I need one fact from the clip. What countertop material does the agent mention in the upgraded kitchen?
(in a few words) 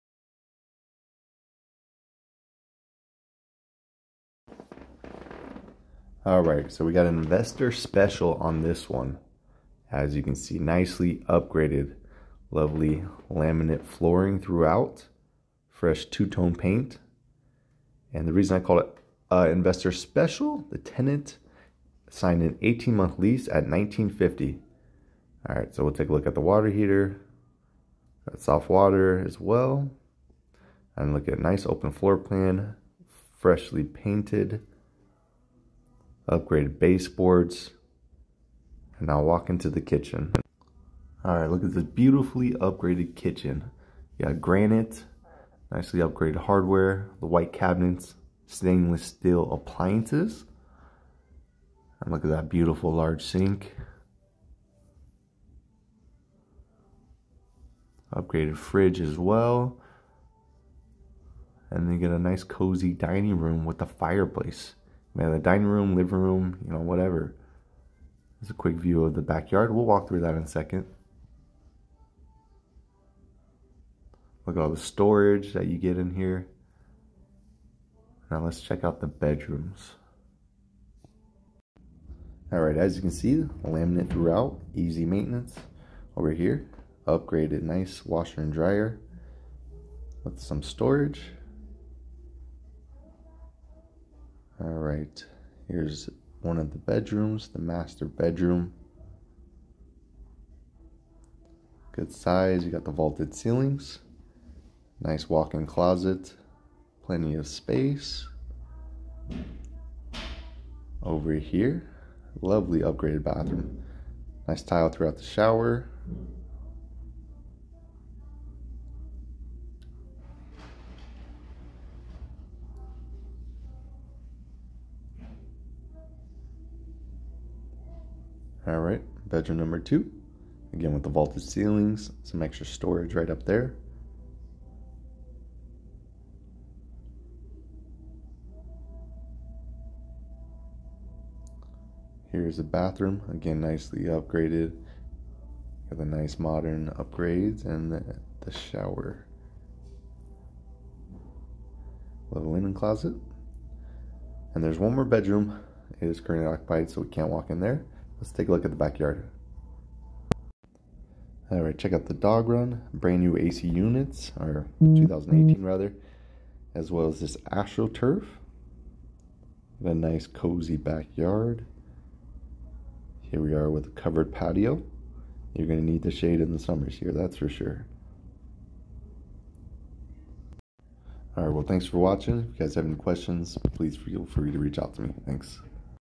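Granite.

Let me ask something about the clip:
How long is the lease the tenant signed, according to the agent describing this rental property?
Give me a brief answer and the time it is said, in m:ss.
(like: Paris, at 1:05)
18 months, at 0:22.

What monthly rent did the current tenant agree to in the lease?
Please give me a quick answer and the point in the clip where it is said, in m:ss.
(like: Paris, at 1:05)
1950, at 0:23.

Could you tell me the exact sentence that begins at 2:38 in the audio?
Let's take a look at the backyard.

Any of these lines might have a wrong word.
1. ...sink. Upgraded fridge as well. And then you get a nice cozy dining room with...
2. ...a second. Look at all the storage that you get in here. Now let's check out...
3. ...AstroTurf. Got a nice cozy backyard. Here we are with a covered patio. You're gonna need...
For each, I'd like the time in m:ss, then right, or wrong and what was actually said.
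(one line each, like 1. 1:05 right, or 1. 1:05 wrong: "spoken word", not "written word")
1. 0:53 right
2. 1:10 right
3. 2:47 right.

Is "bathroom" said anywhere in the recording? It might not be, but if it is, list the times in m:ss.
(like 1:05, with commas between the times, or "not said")
1:53, 2:22.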